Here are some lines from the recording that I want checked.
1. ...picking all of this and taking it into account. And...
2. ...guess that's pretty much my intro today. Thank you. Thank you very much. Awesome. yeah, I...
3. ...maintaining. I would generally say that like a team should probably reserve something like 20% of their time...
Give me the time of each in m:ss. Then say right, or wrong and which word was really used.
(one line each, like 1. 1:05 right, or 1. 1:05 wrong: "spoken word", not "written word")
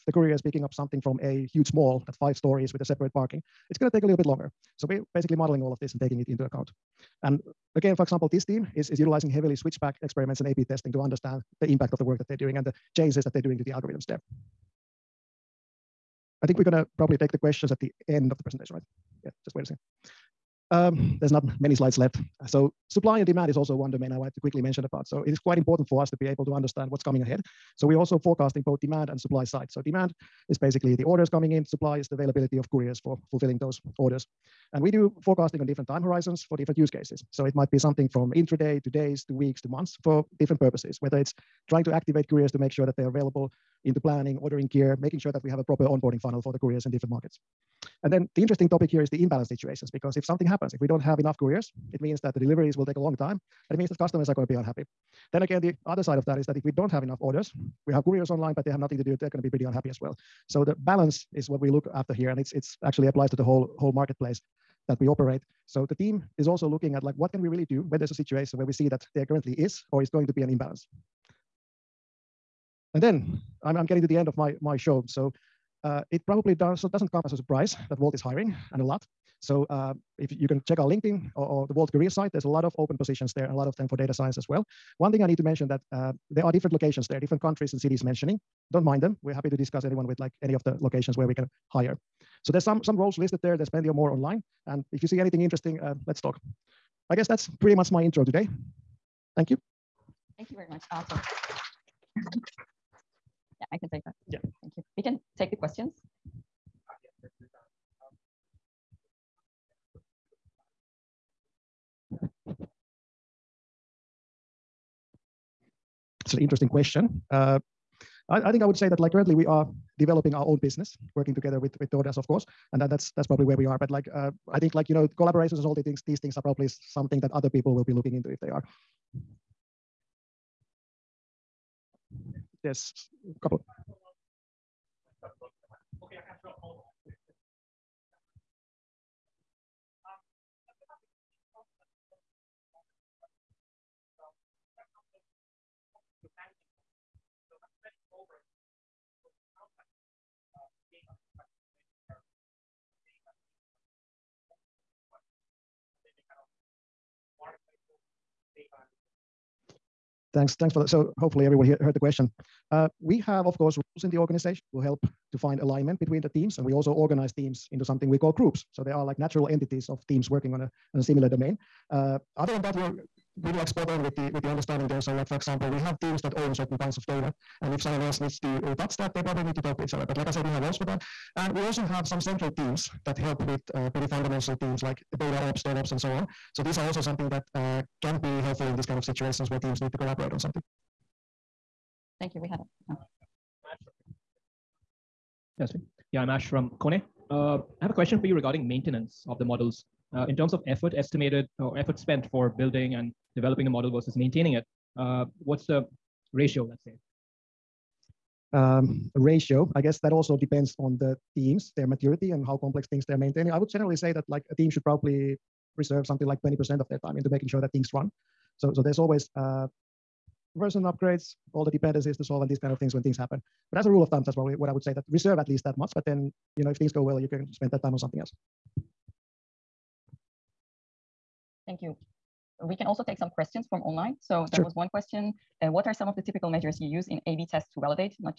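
1. 0:05 wrong: "modeling", not "picking"
2. 1:37 right
3. 3:33 right.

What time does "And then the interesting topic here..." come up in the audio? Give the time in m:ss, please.
0:48.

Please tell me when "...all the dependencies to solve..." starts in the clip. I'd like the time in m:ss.
3:41.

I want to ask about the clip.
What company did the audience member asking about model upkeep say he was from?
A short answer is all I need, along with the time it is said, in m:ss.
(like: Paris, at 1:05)
Kone, at 3:16.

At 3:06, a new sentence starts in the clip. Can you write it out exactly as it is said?
So these are also something that uh, can be helpful in this kind of situations where teams need to collaborate on something.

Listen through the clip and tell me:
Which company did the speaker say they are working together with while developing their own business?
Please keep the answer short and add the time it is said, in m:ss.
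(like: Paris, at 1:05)
DoorDash, at 2:01.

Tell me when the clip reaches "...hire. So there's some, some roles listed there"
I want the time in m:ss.
1:31.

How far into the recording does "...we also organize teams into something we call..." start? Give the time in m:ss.
2:46.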